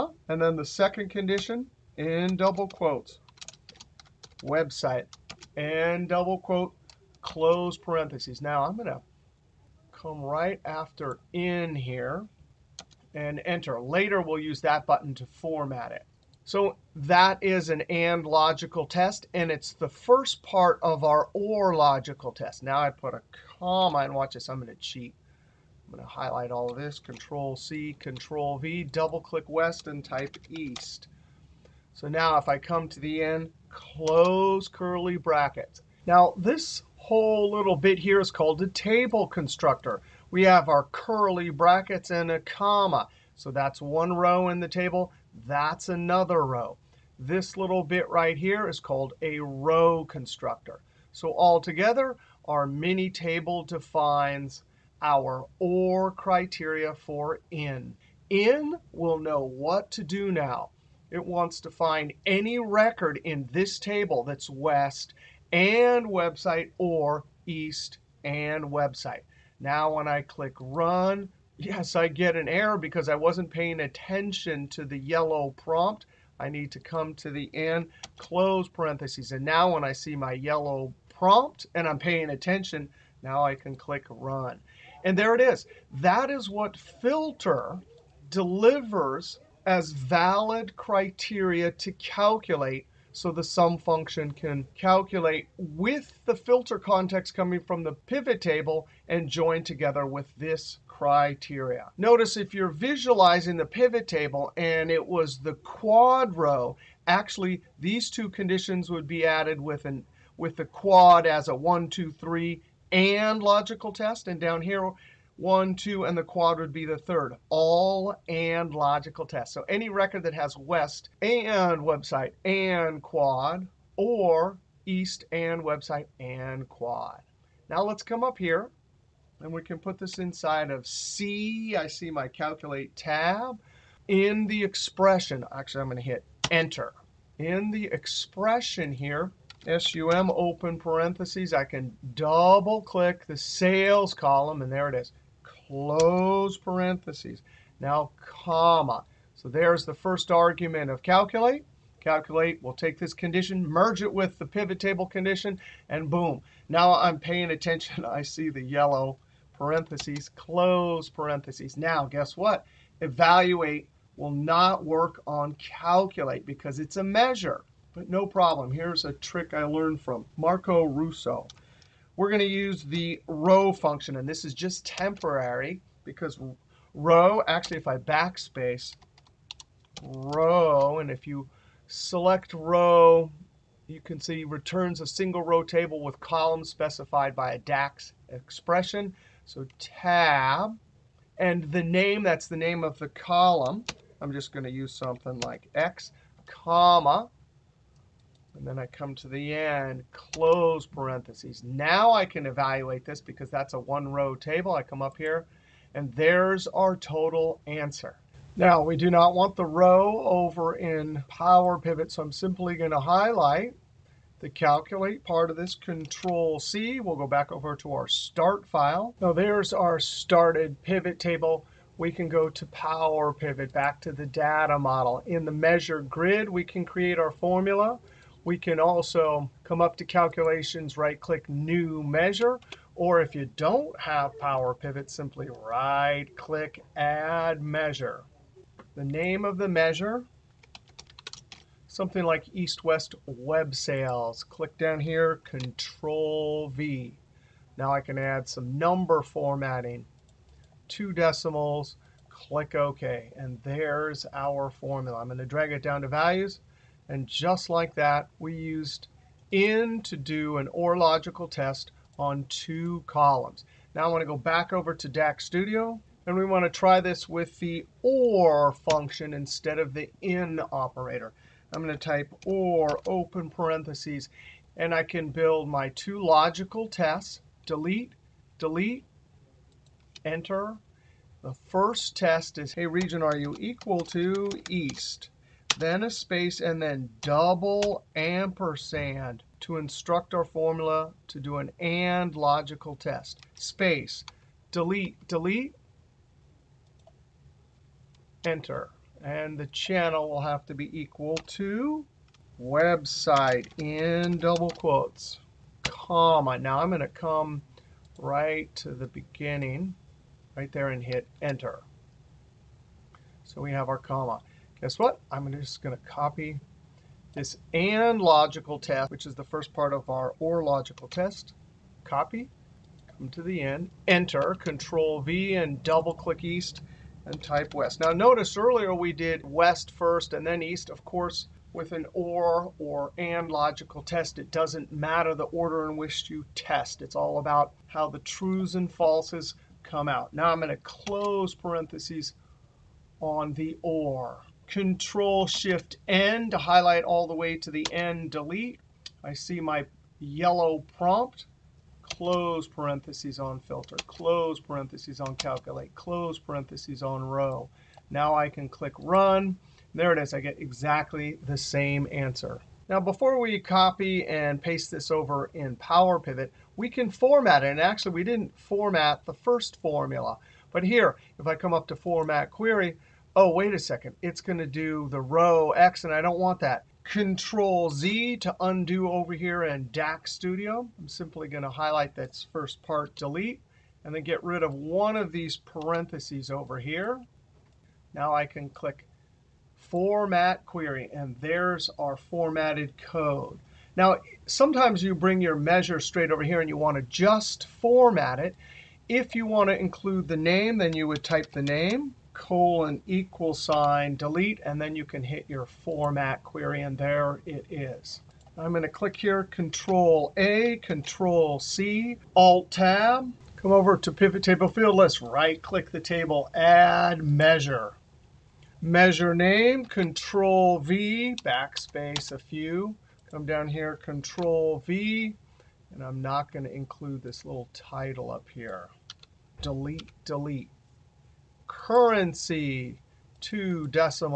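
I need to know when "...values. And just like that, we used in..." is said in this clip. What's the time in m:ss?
4:16.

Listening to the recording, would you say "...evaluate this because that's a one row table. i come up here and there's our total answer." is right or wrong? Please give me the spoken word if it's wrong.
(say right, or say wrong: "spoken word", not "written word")
right.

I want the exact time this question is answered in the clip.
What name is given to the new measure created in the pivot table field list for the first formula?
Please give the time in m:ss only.
4:02.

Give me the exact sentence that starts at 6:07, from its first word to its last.
And actually, we didn't format the first formula.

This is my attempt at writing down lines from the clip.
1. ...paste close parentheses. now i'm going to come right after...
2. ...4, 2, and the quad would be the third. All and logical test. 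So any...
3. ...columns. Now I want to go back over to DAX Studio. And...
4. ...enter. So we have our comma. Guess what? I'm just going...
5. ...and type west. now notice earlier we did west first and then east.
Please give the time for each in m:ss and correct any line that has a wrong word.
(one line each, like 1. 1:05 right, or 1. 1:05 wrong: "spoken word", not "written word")
1. 0:06 wrong: "quote", not "paste"
2. 1:55 wrong: "1", not "4"
3. 4:23 right
4. 5:11 right
5. 5:27 right.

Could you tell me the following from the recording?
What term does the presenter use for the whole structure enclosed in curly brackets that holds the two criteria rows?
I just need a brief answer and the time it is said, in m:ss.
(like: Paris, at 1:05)
table constructor, at 0:38.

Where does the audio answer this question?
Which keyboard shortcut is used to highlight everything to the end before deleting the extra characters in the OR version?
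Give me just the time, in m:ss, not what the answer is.
5:44.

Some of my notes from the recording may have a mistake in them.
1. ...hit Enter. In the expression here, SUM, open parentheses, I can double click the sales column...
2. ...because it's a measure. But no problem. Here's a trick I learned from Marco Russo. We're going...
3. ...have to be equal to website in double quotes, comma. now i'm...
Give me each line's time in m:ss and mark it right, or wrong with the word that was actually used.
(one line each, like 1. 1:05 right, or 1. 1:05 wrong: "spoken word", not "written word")
1. 2:16 right
2. 2:46 right
3. 5:00 right.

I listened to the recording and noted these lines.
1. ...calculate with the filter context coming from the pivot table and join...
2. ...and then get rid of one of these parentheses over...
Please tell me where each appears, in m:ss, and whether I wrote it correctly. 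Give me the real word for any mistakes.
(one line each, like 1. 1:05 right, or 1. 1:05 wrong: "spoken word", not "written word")
1. 1:34 right
2. 6:24 right.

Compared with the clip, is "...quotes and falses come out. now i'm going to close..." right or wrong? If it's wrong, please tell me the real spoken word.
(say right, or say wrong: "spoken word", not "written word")
wrong: "trues", not "quotes".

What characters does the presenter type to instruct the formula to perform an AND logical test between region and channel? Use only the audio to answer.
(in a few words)
double ampersand.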